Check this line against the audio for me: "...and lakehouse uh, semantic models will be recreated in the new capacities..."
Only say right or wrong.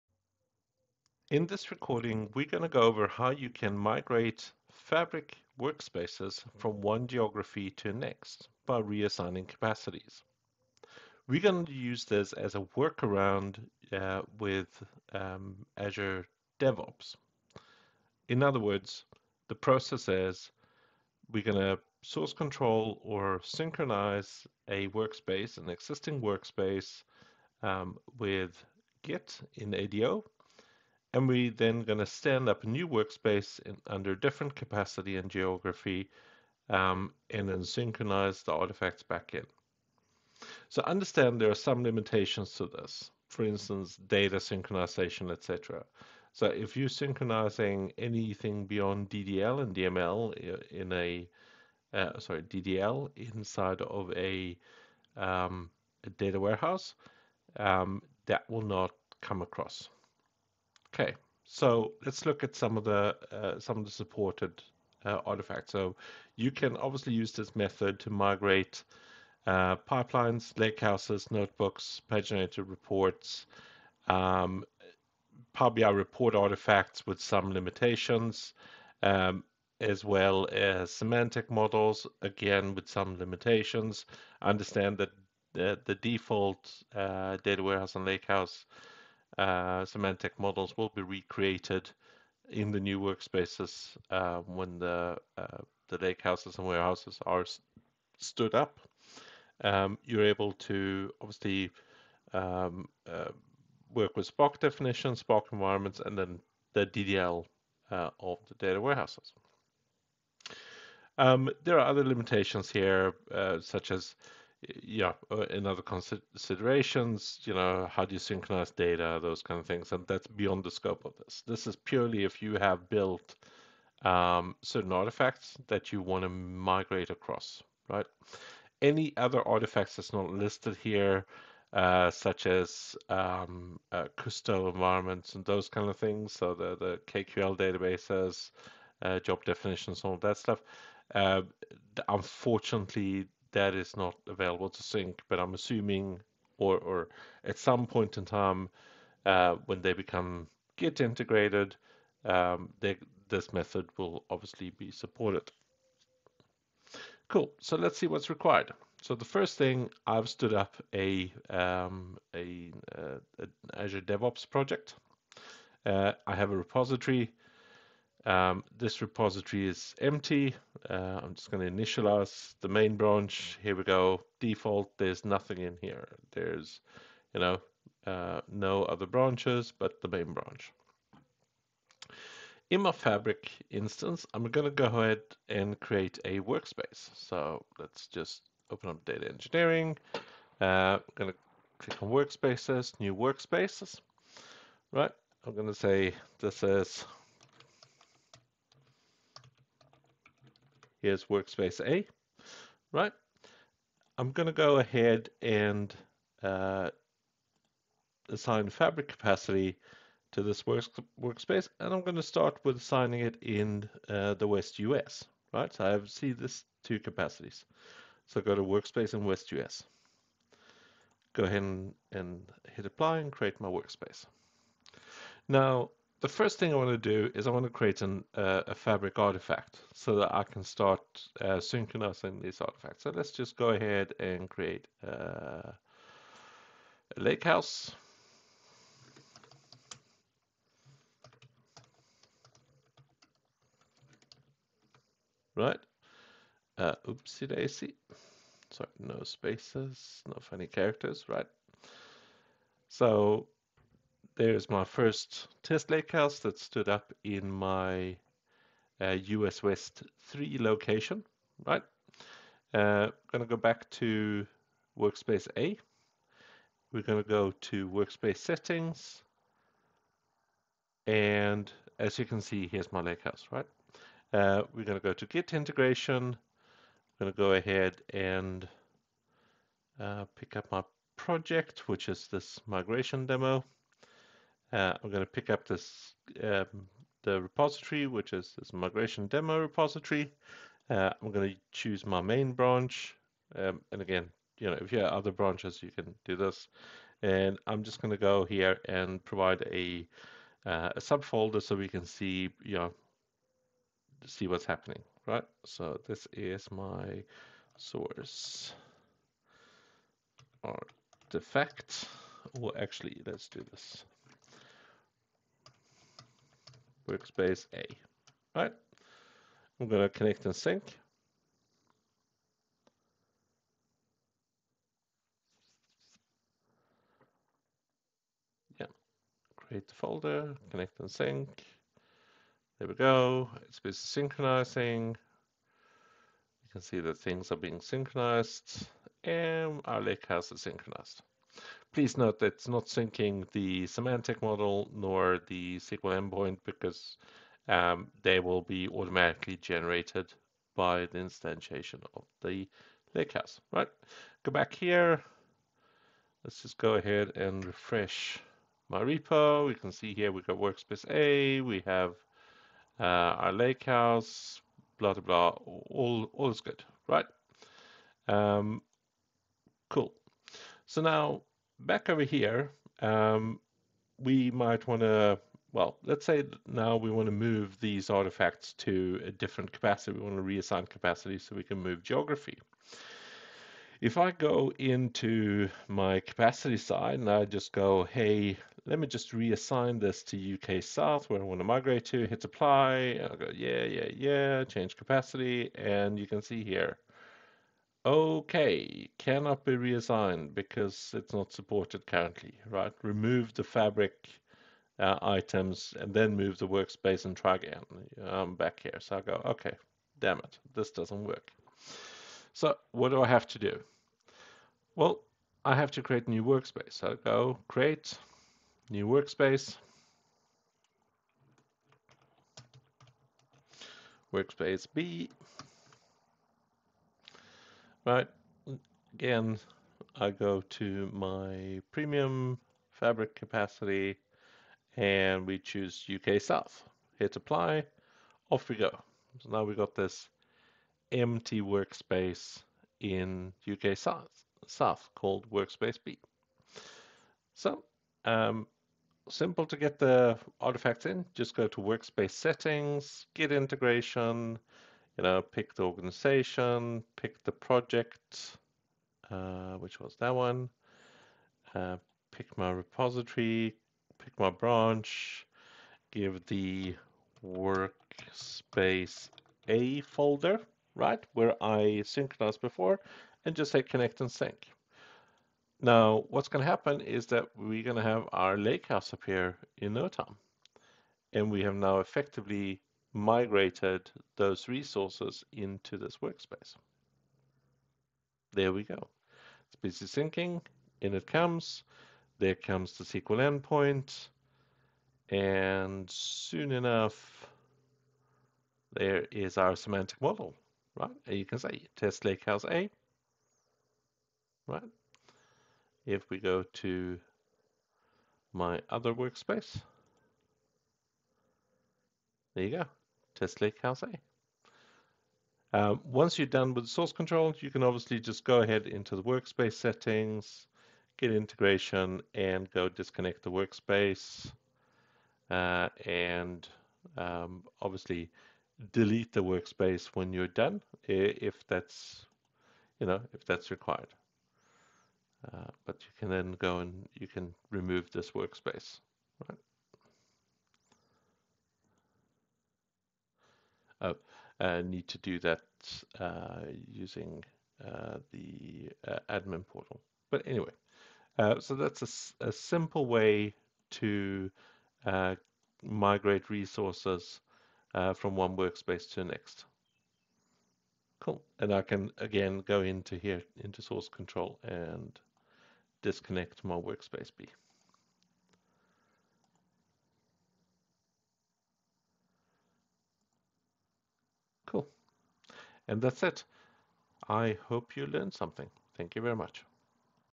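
wrong.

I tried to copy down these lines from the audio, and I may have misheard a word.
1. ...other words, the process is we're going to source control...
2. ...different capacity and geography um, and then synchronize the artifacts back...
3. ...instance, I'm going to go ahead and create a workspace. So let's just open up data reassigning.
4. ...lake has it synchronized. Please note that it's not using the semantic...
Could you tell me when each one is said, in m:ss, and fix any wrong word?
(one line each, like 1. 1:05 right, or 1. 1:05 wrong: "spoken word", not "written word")
1. 0:18 right
2. 0:34 right
3. 3:03 wrong: "engineering", not "reassigning"
4. 5:40 wrong: "syncing", not "using".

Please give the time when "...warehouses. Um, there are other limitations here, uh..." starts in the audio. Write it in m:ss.
1:48.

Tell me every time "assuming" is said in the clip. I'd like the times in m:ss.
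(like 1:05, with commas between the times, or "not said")
2:25.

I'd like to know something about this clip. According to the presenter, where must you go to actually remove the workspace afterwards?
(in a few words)
admin portal.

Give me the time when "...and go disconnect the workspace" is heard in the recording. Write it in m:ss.
8:42.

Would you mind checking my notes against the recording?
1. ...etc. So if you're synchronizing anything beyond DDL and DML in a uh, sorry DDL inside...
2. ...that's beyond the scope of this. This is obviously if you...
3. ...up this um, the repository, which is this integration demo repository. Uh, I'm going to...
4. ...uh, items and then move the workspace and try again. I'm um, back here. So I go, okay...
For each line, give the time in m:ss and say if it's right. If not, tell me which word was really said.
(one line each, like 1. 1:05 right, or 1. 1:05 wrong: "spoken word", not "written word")
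1. 0:45 right
2. 2:00 wrong: "purely", not "obviously"
3. 4:45 wrong: "migration", not "integration"
4. 6:44 right.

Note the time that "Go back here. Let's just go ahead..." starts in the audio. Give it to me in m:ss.
5:54.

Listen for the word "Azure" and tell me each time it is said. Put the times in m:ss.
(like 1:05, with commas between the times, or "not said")
0:15, 2:43.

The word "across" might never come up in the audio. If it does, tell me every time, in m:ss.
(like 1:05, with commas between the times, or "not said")
0:59, 2:07.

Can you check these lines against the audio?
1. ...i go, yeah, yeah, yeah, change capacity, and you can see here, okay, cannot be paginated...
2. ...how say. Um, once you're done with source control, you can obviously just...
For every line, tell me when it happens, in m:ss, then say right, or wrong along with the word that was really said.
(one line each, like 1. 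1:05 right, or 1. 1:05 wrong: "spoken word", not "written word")
1. 6:33 wrong: "reassigned", not "paginated"
2. 8:33 right.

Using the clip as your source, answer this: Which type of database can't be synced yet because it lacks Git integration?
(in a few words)
KQL databases.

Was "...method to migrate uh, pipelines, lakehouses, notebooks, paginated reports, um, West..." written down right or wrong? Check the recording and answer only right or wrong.
wrong.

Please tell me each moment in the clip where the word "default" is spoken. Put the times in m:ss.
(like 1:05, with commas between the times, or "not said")
1:25, 2:54.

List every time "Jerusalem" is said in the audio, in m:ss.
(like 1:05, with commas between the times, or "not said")
not said.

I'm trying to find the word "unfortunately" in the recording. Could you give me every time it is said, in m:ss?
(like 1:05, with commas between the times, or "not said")
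2:22.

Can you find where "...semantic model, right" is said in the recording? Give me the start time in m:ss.
8:19.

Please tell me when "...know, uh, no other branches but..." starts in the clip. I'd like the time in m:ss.
2:57.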